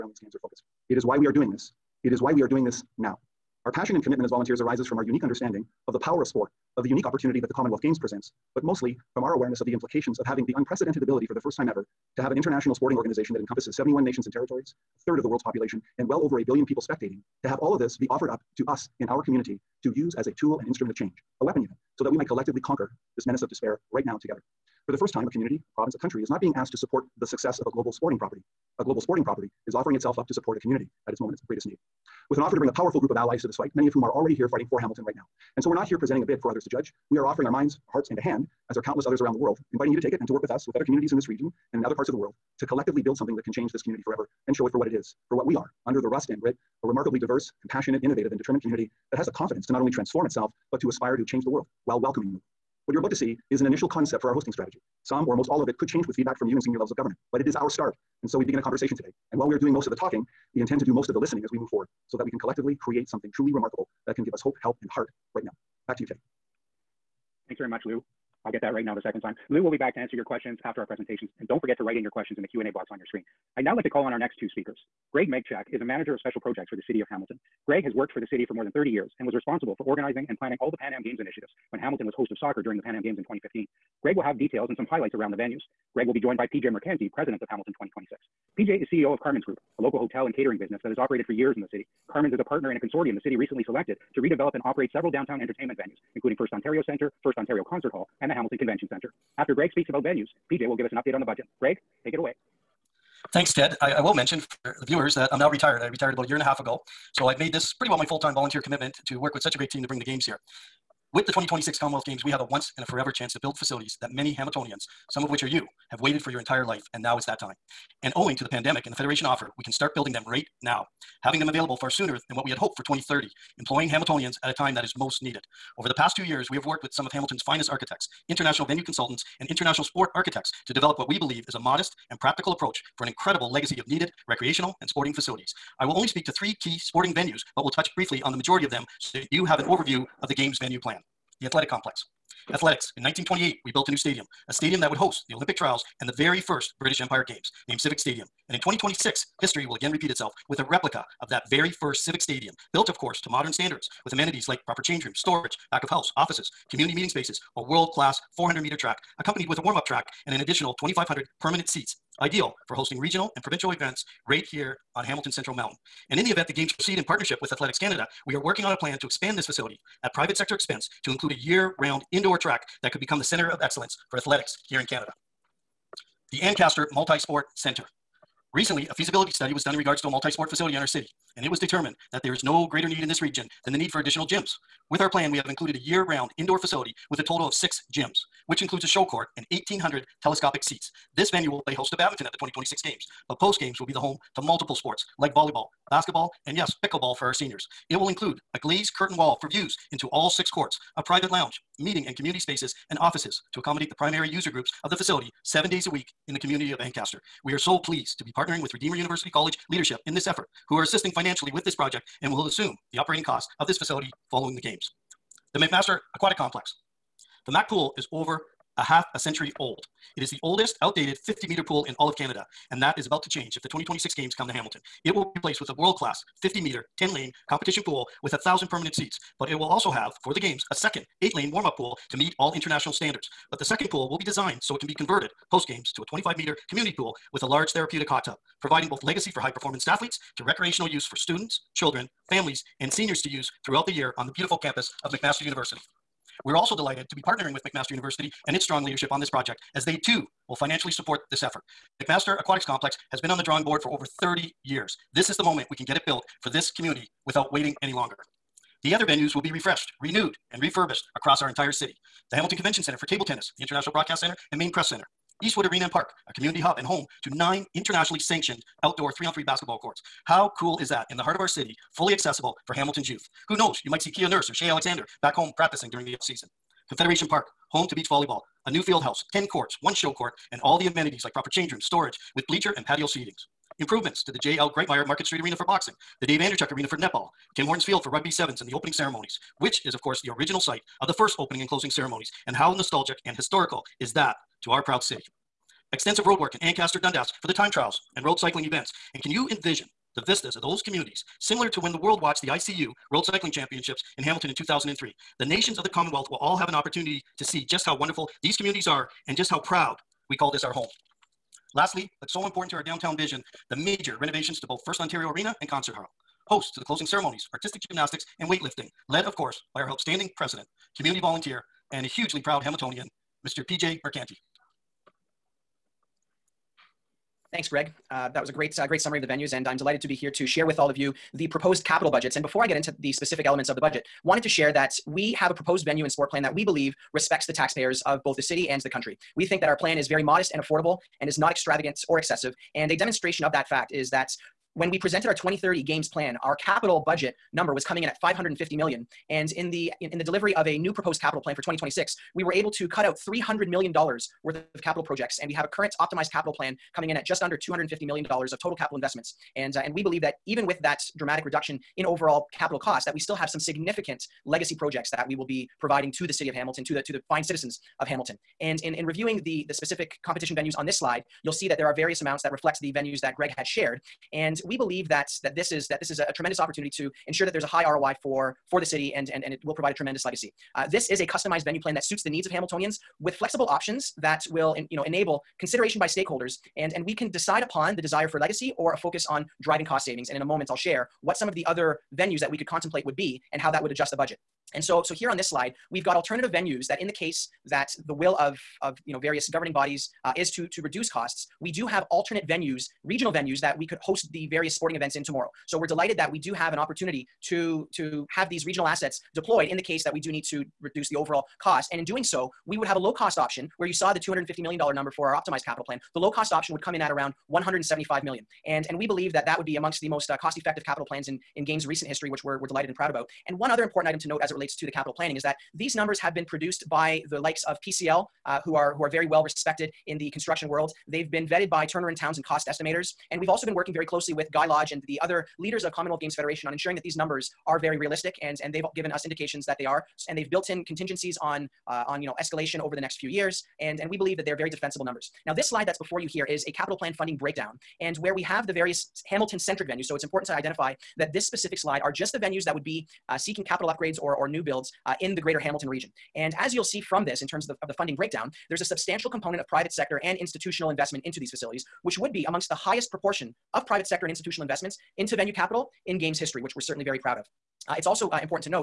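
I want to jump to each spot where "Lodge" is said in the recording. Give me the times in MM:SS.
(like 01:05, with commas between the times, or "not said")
07:14.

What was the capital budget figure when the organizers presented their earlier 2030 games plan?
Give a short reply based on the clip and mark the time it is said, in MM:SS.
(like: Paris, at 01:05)
550 million, at 05:48.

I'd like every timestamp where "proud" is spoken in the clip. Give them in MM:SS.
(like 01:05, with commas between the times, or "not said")
04:54, 05:09, 05:22, 07:02, 07:47.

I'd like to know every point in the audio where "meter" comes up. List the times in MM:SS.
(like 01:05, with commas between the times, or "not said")
02:38, 03:41, 03:46, 03:56.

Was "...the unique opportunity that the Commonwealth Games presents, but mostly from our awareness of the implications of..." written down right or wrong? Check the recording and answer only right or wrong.
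right.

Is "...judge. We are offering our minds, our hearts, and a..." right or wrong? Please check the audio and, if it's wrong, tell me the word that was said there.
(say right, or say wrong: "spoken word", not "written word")
right.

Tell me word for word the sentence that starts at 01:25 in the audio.
Greg will be joined by PJ Mercanti, president of Hamilton 2026.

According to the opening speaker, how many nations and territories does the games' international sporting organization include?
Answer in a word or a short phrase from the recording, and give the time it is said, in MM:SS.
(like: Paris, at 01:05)
71, at 00:13.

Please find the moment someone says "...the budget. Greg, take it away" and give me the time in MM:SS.
01:41.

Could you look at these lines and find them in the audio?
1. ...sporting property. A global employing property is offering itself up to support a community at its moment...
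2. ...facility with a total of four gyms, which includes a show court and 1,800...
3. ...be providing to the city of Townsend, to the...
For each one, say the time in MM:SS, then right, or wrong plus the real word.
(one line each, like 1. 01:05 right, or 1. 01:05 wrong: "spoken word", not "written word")
1. 00:27 wrong: "sporting", not "employing"
2. 03:06 wrong: "six", not "four"
3. 06:05 wrong: "Hamilton", not "Townsend".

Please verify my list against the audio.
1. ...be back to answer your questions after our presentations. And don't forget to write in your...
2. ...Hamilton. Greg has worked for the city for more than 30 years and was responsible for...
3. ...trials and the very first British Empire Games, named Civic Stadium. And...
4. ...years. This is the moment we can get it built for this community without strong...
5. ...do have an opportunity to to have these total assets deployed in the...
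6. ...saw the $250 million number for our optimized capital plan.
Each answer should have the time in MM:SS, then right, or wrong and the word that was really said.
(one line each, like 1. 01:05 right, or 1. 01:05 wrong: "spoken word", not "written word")
1. 01:09 right
2. 01:17 right
3. 02:25 right
4. 04:14 wrong: "waiting", not "strong"
5. 06:46 wrong: "regional", not "total"
6. 06:53 right.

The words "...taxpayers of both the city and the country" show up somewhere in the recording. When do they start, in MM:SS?
05:37.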